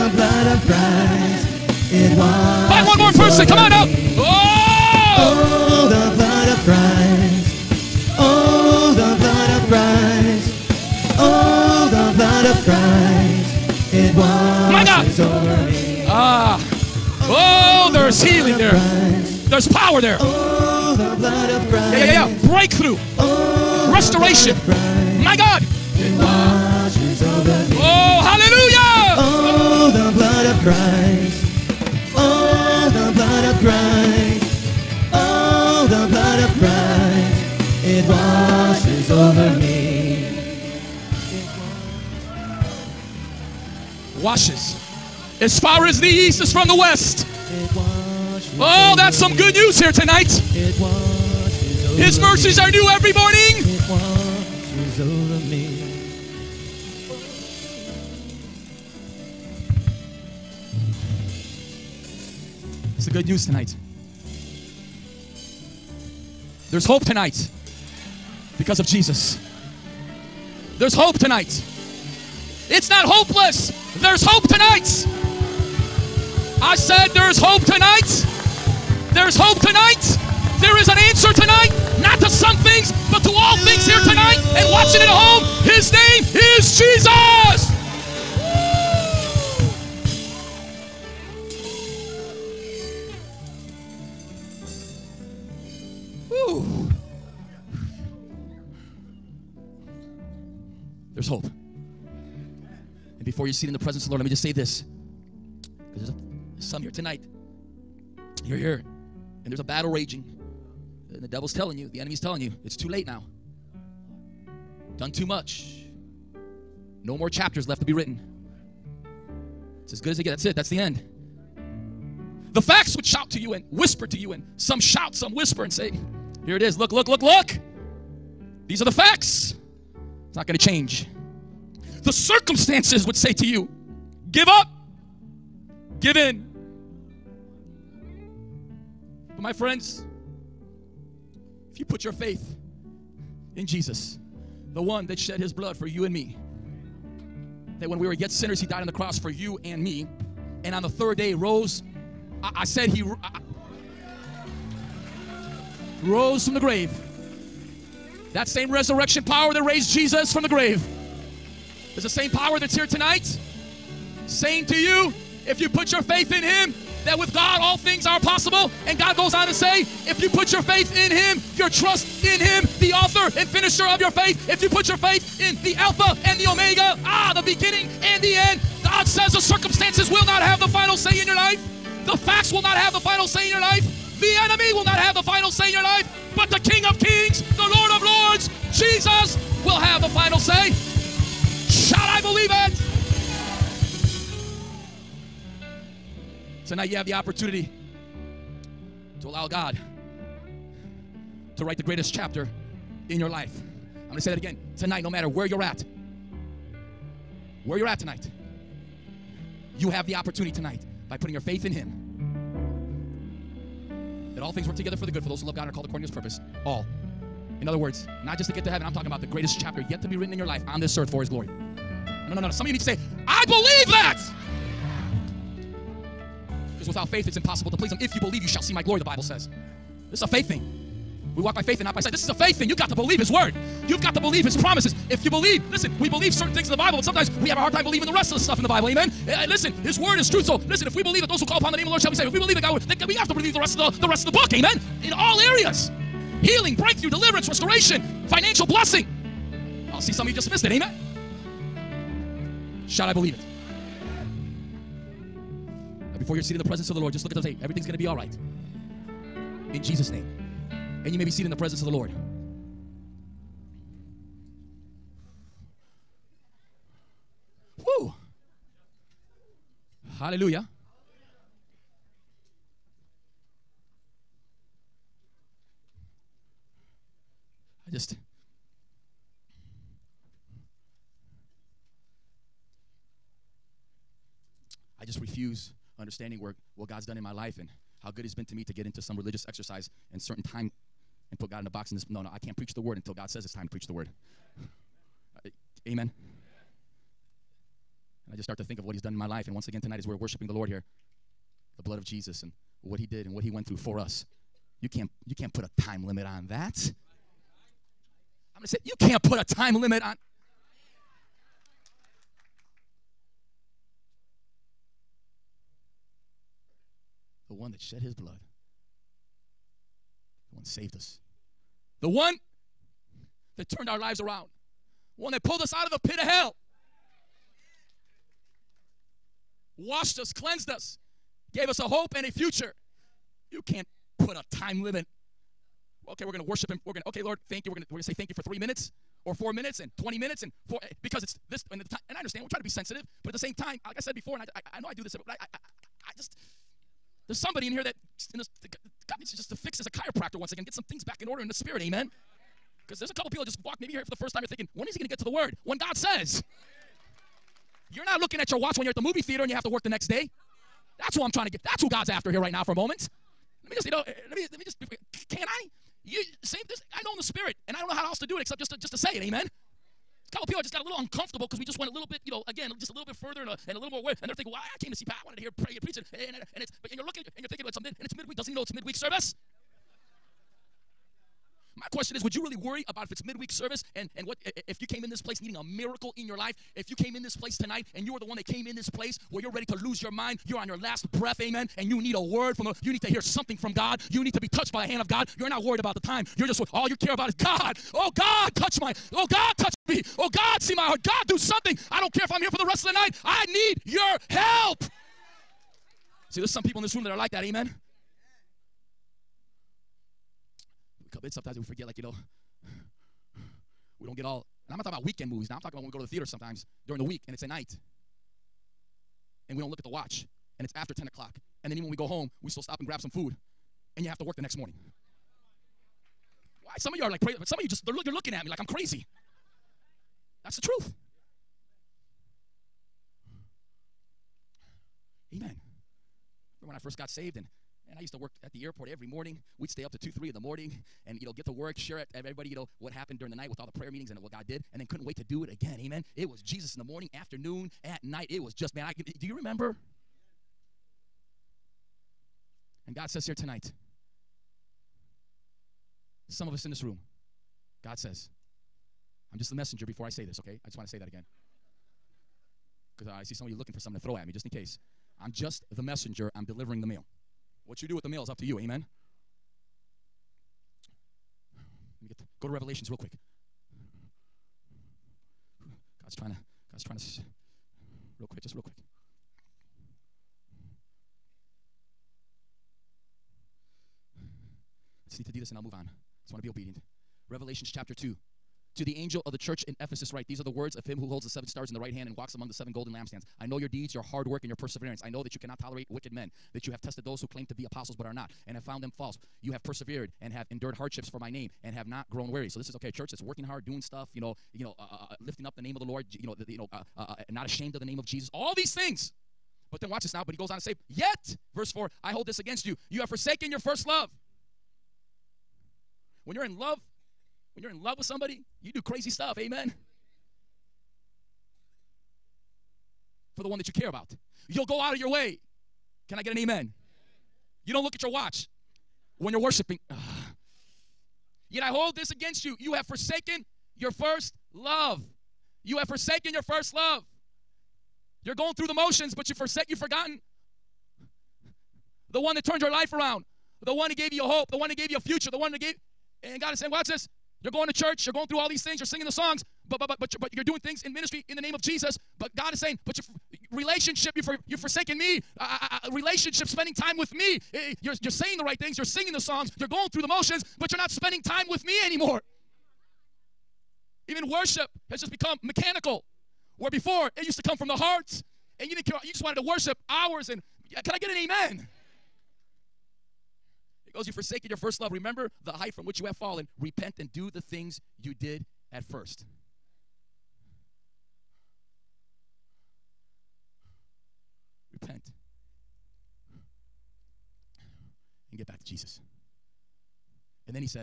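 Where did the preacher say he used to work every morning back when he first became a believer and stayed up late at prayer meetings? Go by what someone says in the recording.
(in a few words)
the airport.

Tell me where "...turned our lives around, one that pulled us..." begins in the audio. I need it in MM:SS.
05:23.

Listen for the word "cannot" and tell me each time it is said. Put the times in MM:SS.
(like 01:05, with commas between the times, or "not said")
08:15.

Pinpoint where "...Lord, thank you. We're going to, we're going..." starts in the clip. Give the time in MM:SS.
05:37.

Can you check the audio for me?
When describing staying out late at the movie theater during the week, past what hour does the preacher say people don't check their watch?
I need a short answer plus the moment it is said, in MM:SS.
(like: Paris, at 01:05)
10 o'clock, at 07:00.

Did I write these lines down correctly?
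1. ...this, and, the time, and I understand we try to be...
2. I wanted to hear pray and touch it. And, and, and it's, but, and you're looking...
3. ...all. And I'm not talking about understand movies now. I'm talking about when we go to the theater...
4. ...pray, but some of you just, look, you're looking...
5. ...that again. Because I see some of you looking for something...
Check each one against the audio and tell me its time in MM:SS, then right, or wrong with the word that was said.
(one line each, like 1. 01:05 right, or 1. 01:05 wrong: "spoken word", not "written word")
1. 05:41 right
2. 06:15 wrong: "preach", not "touch"
3. 06:54 wrong: "weekend", not "understand"
4. 07:07 right
5. 07:40 right.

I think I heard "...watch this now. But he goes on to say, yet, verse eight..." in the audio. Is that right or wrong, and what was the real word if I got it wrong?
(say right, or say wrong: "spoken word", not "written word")
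wrong: "four", not "eight".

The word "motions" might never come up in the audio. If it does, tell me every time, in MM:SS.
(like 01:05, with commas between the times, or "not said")
08:58, 09:20.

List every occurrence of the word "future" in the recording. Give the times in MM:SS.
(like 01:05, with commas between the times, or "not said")
05:32, 09:04.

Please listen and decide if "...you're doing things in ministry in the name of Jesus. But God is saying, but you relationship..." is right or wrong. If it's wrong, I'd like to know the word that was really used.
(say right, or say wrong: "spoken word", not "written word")
right.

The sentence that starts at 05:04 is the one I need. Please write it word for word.
You can't, you can't put a time limit on that.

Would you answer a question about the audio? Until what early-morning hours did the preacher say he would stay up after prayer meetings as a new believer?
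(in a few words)
2 or 3 in the morning.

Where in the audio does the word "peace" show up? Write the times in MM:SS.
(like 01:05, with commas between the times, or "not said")
not said.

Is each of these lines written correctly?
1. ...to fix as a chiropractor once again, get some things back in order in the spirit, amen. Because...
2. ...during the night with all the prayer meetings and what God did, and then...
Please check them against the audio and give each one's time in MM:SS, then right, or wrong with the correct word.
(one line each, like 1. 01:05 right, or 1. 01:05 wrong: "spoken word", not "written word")
1. 05:49 right
2. 07:23 right.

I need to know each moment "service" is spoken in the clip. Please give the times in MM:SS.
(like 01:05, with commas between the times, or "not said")
06:18, 06:23.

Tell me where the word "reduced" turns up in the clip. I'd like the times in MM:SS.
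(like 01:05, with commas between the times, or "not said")
not said.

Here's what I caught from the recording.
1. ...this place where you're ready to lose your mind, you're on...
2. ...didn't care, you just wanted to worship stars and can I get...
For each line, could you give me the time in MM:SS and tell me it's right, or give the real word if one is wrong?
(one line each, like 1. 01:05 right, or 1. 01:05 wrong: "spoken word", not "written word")
1. 06:28 right
2. 09:28 wrong: "hours", not "stars".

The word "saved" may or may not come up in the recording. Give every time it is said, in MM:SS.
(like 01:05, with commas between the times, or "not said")
04:02, 05:20, 07:17.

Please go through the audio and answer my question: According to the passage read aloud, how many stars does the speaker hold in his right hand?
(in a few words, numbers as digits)
7.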